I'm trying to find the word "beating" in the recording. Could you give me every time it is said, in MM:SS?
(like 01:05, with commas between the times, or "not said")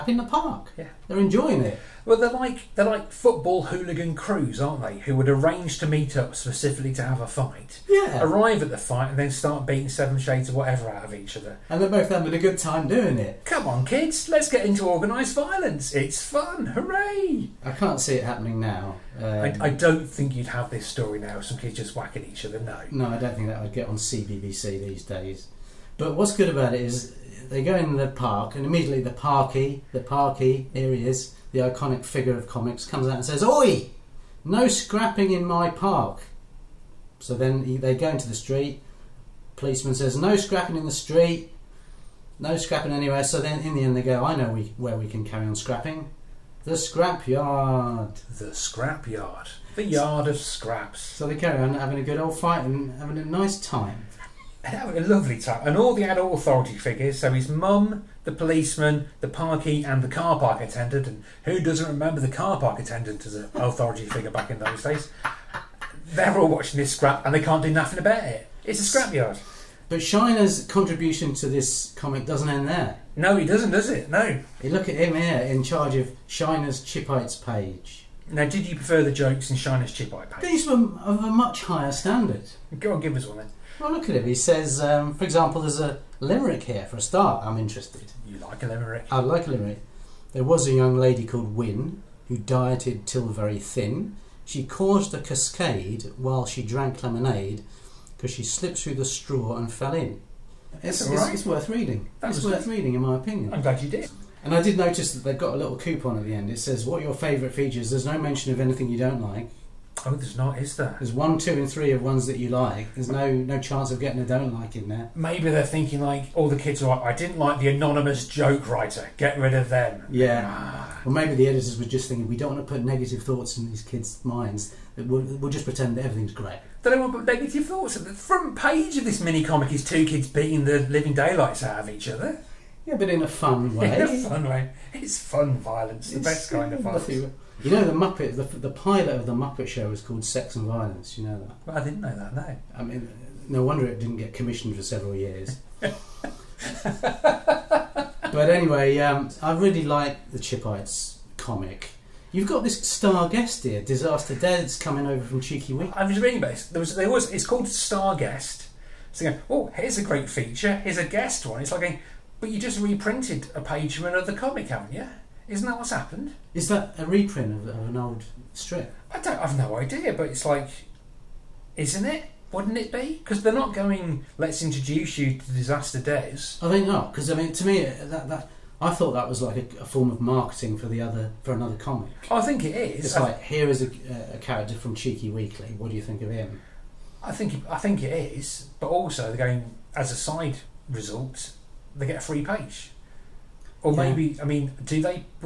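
00:09, 02:10.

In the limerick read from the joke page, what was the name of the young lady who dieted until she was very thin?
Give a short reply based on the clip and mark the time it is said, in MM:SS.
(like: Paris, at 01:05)
Wynne, at 01:31.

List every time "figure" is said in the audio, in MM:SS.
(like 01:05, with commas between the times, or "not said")
00:32, 00:56, 01:04.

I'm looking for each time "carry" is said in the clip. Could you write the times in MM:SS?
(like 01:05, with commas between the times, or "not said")
00:45, 00:51.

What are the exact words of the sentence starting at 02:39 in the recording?
So oh, here's a great feature.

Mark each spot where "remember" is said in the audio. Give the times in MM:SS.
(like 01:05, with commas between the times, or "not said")
01:01.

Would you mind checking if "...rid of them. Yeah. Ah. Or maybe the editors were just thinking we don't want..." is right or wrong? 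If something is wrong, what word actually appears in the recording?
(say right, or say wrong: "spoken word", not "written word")
right.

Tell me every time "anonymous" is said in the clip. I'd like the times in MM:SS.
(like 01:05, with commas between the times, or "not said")
01:57.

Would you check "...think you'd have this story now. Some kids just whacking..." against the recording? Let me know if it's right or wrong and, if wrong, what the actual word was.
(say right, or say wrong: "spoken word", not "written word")
right.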